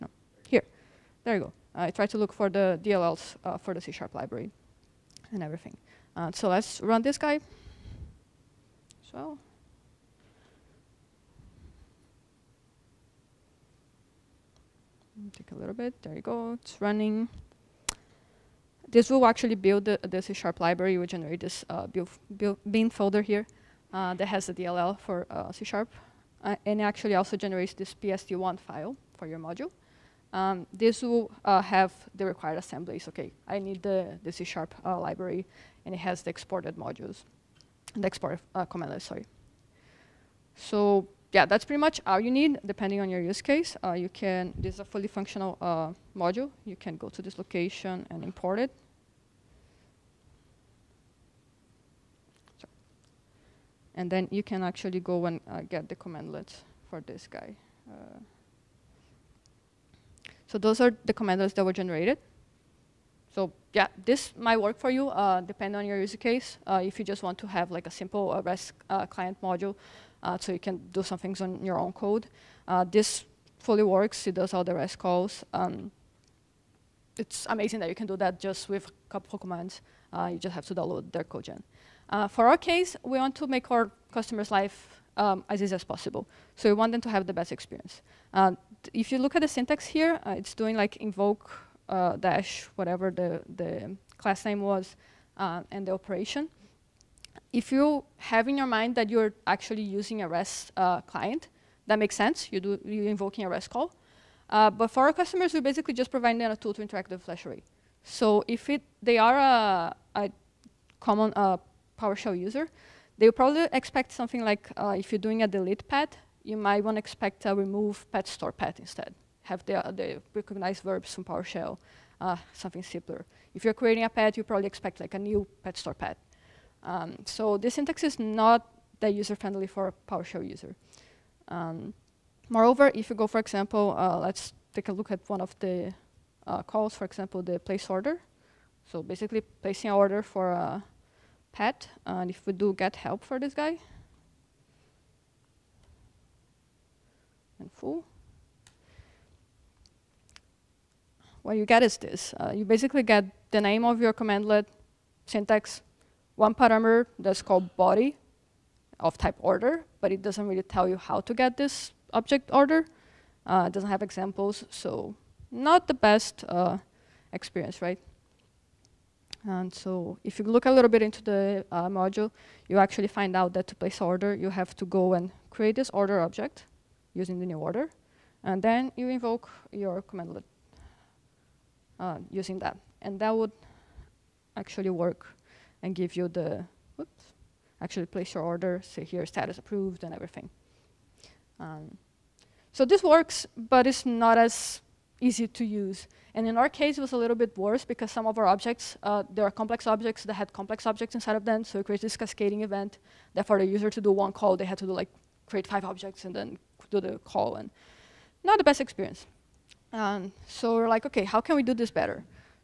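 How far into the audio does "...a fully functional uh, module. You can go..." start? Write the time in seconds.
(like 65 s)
44 s.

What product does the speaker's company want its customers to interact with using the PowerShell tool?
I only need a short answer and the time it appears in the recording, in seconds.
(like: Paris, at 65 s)
Flash Array, at 107 s.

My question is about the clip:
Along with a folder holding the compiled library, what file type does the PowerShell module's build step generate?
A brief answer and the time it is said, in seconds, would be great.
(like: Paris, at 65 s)
PSD1 file, at 27 s.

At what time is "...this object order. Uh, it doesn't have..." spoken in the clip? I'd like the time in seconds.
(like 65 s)
161 s.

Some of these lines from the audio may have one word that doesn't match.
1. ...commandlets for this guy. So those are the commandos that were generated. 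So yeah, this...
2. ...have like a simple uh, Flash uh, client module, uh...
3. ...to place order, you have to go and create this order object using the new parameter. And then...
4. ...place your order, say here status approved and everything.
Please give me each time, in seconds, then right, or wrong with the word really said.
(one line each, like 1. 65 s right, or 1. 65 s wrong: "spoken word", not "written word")
1. 55 s right
2. 67 s wrong: "REST", not "Flash"
3. 173 s wrong: "order", not "parameter"
4. 188 s right.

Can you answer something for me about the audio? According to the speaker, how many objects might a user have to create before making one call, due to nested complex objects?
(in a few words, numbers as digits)
5.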